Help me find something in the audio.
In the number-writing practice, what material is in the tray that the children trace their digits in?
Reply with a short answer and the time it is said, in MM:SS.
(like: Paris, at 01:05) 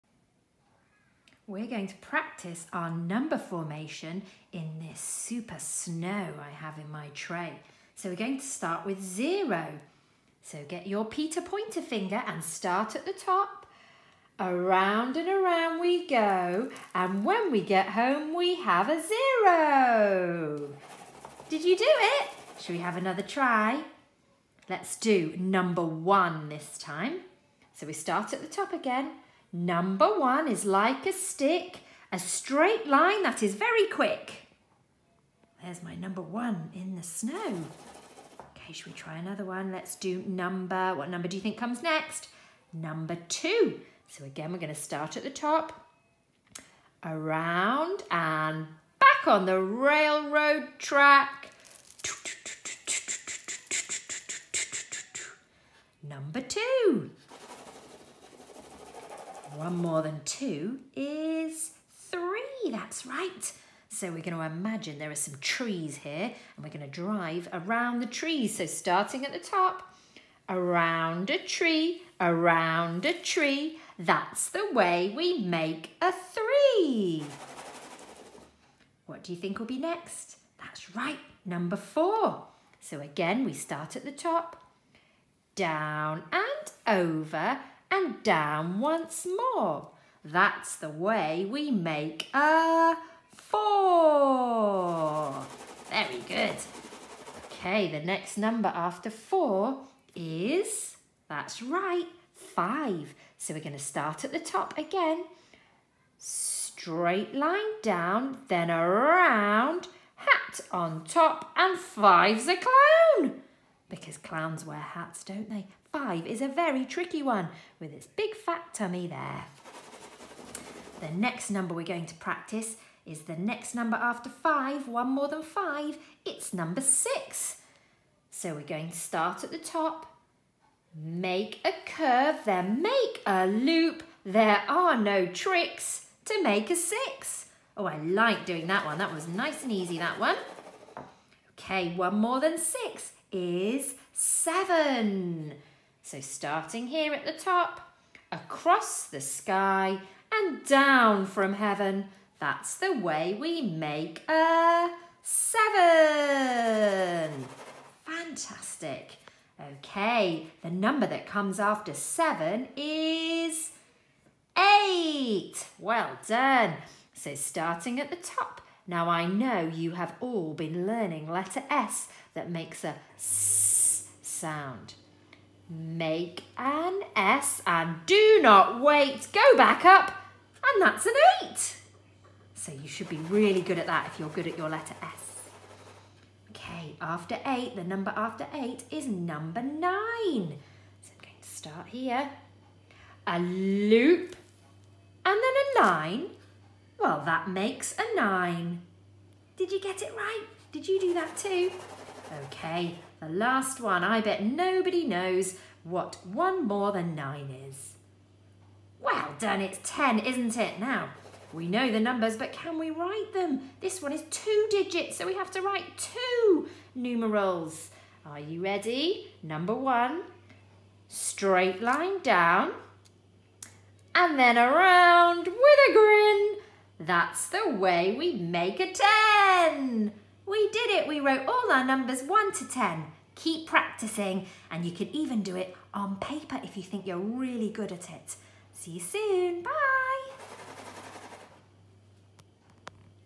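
super snow, at 00:05.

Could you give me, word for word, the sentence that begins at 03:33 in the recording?
This one is two digits, so we have to write two numerals.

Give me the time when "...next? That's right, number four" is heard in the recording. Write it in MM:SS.
01:19.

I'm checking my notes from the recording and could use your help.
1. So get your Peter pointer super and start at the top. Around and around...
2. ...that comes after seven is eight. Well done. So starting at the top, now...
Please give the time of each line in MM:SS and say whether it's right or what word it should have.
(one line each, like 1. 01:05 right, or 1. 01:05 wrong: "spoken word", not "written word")
1. 00:10 wrong: "finger", not "super"
2. 02:41 right.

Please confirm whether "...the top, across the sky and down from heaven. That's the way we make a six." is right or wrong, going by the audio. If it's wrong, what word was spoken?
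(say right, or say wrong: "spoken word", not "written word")
wrong: "seven", not "six".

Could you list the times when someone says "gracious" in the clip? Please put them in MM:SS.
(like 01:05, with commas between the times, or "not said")
not said.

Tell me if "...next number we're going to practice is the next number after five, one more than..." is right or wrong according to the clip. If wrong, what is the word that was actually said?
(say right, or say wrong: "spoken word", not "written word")
right.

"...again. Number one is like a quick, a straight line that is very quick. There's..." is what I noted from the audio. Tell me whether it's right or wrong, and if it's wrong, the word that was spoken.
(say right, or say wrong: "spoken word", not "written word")
wrong: "stick", not "quick".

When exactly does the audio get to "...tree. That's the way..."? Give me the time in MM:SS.
01:13.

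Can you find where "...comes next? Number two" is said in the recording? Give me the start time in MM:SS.
00:41.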